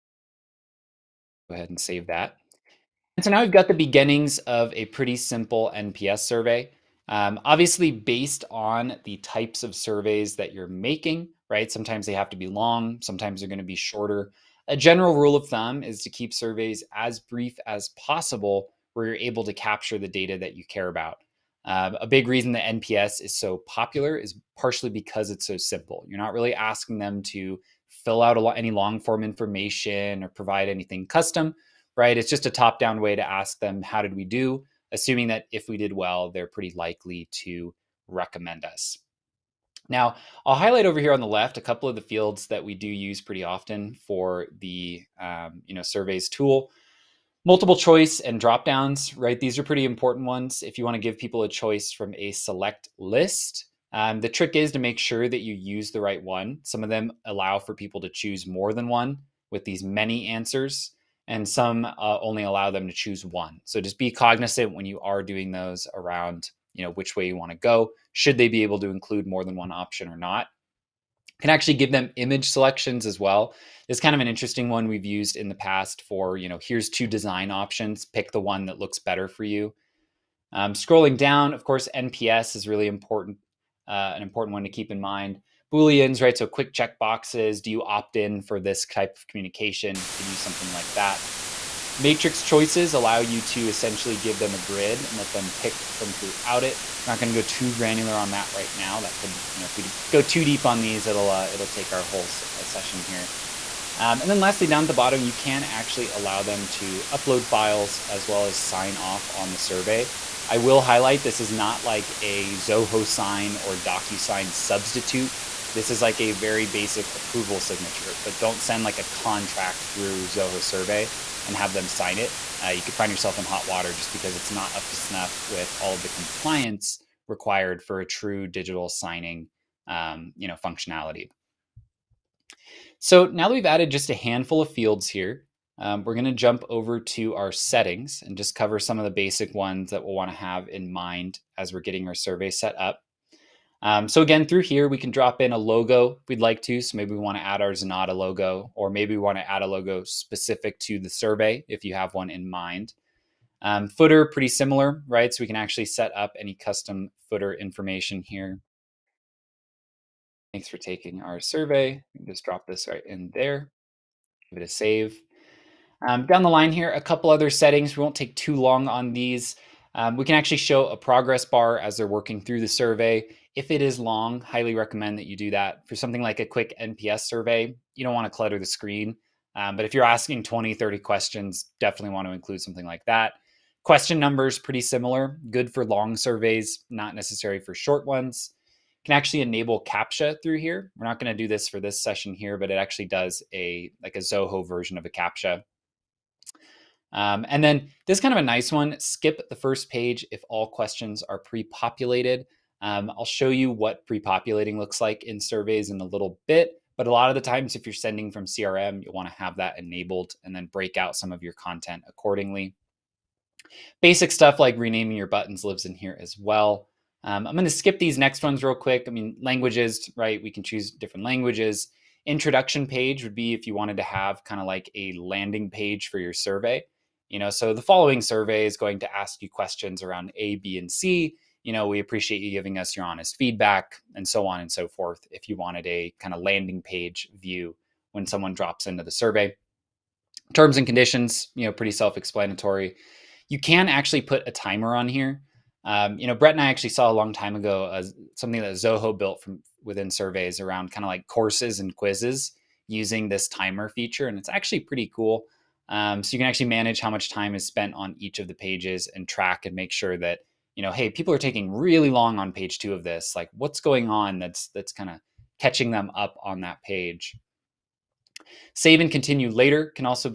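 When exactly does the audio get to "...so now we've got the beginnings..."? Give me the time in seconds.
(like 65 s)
3 s.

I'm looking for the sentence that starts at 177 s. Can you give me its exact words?
You don't want to clutter the screen.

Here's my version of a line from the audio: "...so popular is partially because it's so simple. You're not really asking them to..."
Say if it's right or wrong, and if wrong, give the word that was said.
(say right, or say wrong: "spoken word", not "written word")
right.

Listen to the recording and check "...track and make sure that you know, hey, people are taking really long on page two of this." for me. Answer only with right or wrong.
right.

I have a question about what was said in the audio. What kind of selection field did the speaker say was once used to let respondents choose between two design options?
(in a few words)
Image selections.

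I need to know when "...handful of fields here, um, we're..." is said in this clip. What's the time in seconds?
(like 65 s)
134 s.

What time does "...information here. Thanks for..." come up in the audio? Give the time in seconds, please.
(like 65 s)
157 s.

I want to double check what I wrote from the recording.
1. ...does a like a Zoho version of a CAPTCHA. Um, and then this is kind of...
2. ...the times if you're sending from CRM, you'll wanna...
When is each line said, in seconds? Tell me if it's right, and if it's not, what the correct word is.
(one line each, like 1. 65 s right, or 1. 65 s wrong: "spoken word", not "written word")
1. 193 s right
2. 207 s right.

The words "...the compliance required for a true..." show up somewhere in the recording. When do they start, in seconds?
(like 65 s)
126 s.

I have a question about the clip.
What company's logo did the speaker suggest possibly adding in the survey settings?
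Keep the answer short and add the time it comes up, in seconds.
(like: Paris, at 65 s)
Zenatta, at 147 s.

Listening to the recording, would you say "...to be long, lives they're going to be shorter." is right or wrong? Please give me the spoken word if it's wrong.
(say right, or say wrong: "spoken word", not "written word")
wrong: "sometimes", not "lives".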